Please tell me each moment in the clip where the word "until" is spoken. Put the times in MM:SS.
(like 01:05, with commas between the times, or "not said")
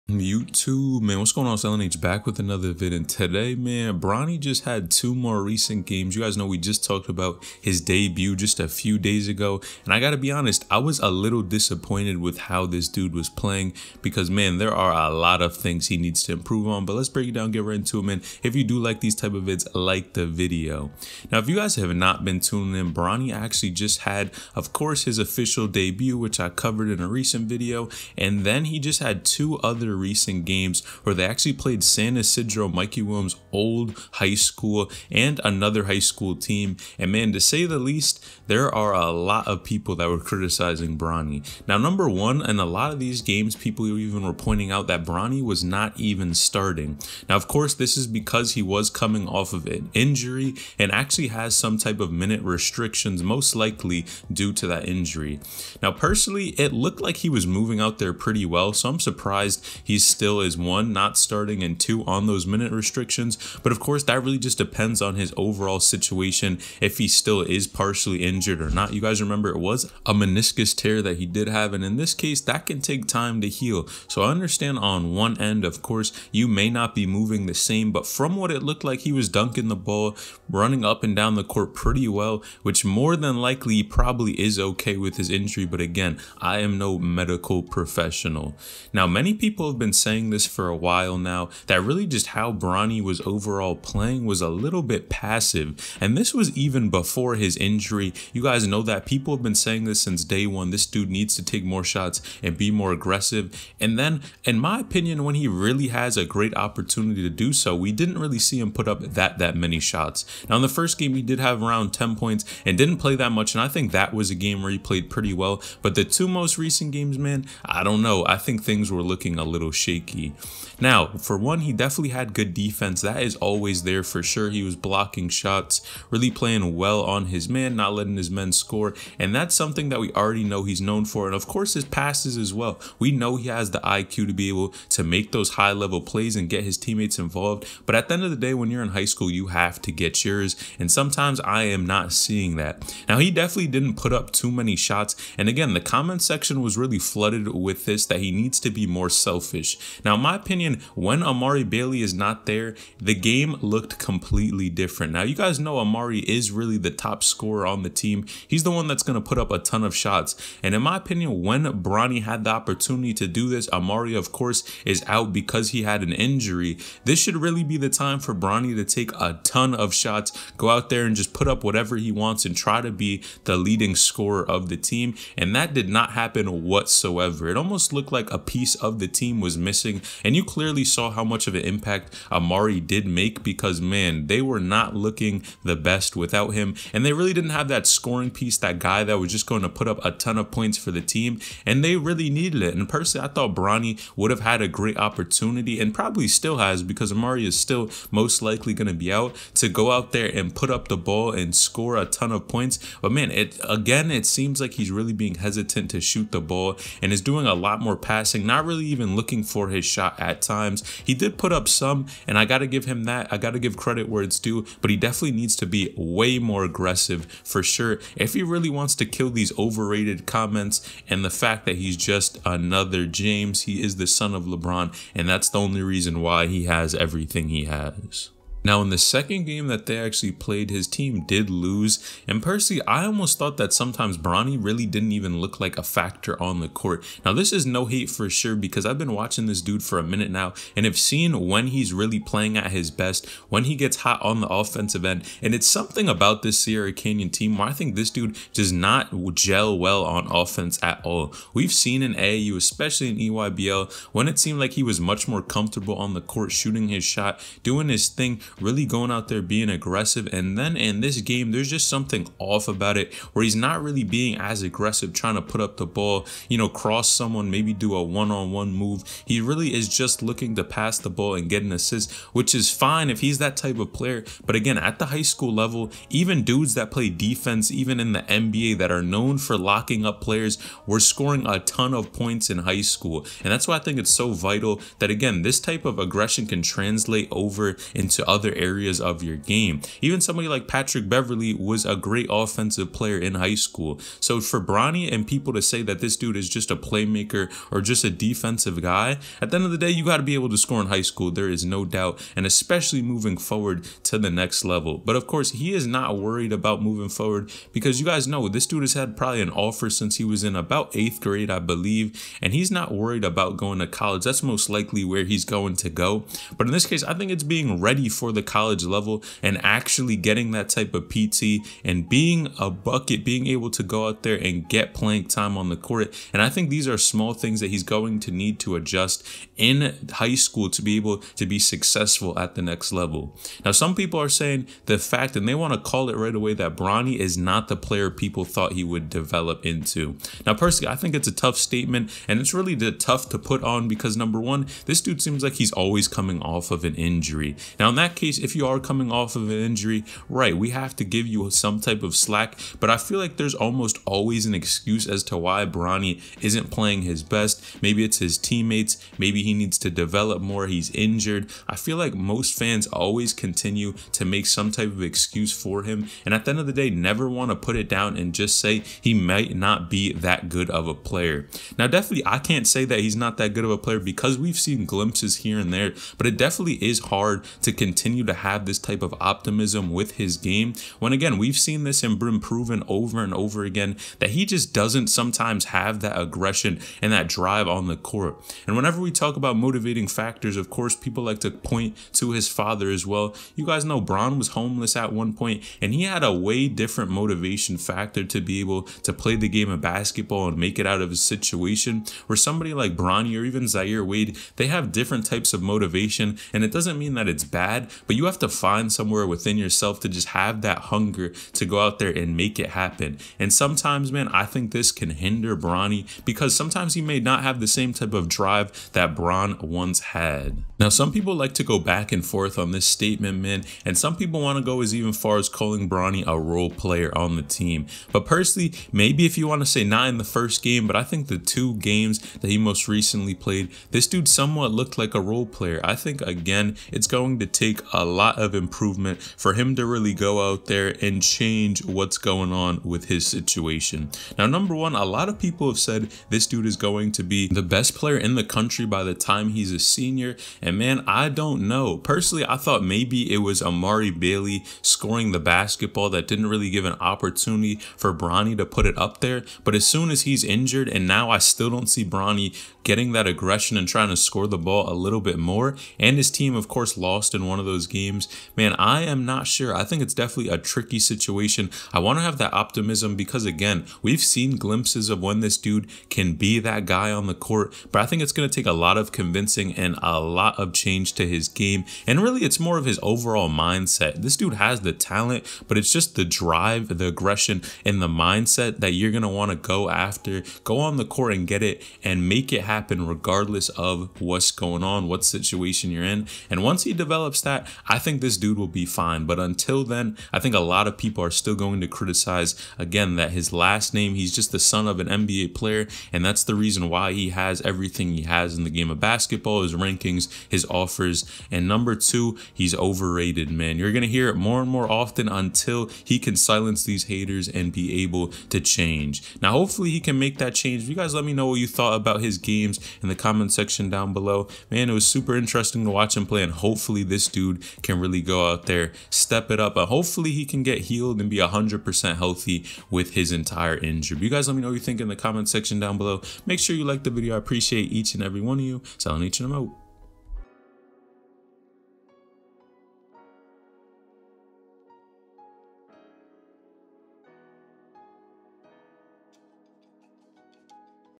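08:19, 08:35.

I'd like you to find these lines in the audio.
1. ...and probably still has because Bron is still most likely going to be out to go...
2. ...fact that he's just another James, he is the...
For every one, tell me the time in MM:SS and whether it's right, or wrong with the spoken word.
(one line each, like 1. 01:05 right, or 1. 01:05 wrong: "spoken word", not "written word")
1. 03:15 wrong: "Amari", not "Bron"
2. 03:41 right.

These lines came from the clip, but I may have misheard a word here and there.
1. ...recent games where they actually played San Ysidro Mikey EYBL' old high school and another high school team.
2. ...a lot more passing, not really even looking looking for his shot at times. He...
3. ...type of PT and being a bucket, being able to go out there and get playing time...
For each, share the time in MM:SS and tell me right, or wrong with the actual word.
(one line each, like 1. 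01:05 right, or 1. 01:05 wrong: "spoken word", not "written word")
1. 00:30 wrong: "Williams", not "EYBL"
2. 03:27 right
3. 05:20 right.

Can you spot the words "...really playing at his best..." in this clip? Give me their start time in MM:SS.
04:01.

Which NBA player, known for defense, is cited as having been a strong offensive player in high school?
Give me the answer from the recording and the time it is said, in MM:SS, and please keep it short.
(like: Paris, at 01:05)
Patrick Beverley, at 04:50.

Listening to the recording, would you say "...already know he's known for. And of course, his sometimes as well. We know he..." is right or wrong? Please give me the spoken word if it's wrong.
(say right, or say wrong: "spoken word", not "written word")
wrong: "passes", not "sometimes".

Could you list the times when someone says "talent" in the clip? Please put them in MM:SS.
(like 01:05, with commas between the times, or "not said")
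08:04.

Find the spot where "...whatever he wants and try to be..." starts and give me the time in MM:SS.
02:51.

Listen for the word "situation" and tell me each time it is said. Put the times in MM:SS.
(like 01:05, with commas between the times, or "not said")
01:05, 06:41, 07:23, 07:50, 08:15.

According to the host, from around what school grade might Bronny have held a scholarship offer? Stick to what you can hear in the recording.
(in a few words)
Eighth grade.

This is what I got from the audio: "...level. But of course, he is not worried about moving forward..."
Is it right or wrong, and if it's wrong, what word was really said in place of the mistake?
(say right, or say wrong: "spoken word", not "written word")
right.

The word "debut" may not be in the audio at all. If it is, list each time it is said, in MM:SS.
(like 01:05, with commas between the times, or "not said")
00:07, 00:25.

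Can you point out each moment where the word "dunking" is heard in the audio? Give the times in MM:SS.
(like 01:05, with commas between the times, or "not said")
01:19.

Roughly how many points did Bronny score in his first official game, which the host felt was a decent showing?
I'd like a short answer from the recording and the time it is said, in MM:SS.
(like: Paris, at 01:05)
10, at 01:51.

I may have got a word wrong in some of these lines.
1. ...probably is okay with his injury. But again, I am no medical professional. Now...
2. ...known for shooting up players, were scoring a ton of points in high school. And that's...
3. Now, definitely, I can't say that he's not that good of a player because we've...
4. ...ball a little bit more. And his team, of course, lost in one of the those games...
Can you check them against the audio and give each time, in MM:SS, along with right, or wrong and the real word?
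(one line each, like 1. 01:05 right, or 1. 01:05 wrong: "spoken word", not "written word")
1. 01:23 right
2. 04:39 wrong: "locking", not "shooting"
3. 06:11 right
4. 07:44 right.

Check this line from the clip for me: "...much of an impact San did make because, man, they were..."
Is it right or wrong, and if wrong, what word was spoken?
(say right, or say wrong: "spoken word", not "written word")
wrong: "Amari", not "San".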